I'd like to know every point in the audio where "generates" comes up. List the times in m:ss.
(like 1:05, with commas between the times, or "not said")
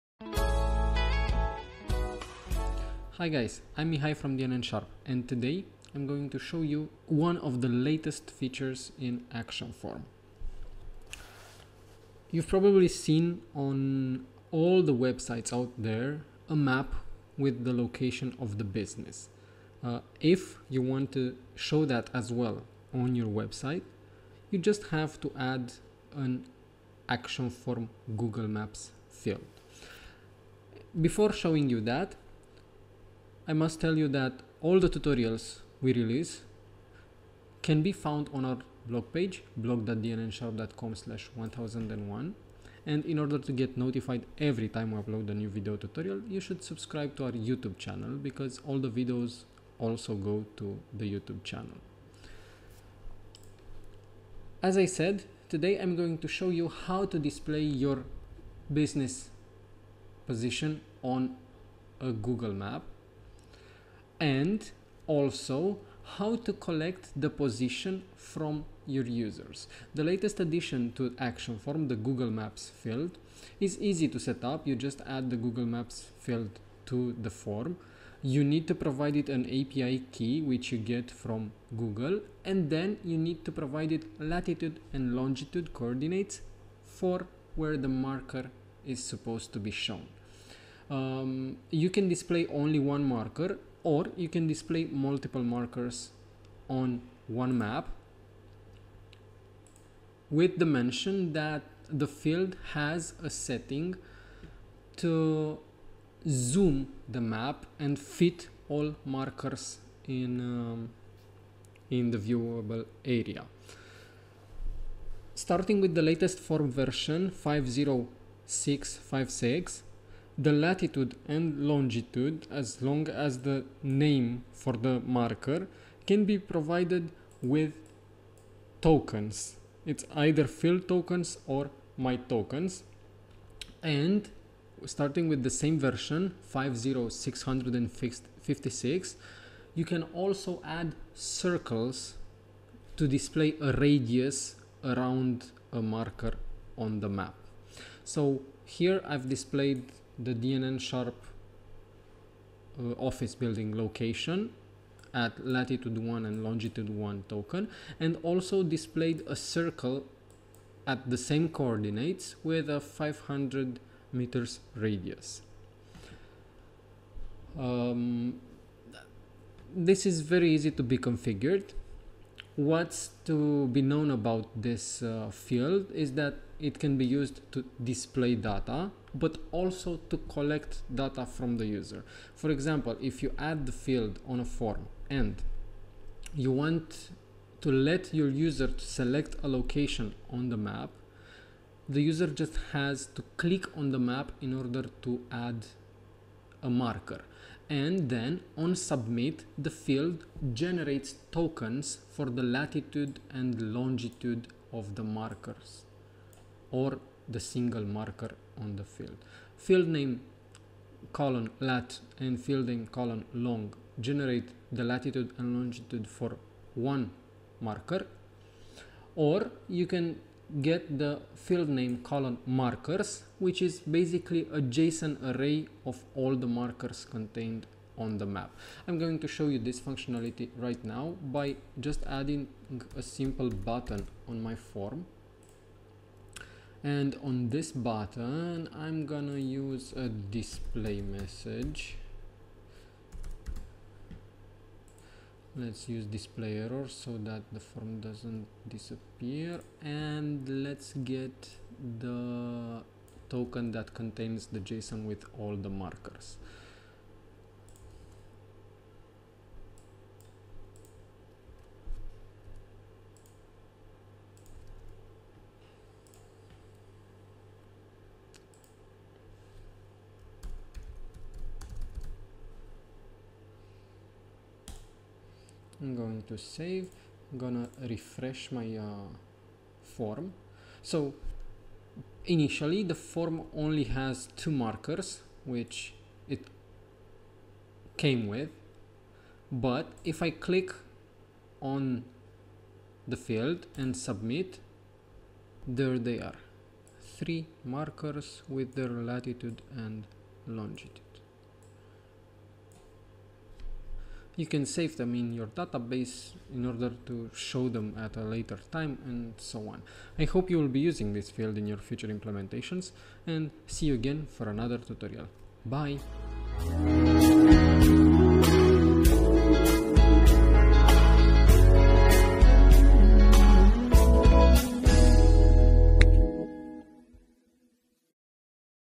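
3:20, 3:33.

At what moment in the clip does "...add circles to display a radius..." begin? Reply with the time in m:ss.
2:20.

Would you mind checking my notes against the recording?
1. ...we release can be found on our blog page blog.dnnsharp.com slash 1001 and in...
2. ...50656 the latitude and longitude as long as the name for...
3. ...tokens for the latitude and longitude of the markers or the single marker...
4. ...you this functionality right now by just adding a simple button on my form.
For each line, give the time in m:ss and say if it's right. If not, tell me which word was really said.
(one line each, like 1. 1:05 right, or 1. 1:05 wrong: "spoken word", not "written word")
1. 0:35 right
2. 1:57 right
3. 3:21 right
4. 3:49 right.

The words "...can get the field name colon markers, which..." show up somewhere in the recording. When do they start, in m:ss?
3:39.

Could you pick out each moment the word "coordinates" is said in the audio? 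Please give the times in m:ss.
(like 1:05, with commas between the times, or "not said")
1:25, 2:41.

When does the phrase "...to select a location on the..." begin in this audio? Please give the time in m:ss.
3:08.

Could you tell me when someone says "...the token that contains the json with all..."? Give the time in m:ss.
4:11.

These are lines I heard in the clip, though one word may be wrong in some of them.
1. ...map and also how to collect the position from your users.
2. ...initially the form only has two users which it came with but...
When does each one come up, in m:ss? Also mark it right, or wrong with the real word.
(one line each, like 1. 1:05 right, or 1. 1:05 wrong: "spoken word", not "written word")
1. 1:02 right
2. 4:42 wrong: "markers", not "users".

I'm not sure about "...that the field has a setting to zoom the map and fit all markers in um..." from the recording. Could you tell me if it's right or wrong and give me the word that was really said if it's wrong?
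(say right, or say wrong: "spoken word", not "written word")
right.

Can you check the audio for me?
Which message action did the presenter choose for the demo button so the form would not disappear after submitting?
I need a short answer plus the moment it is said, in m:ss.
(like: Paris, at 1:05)
display error, at 4:06.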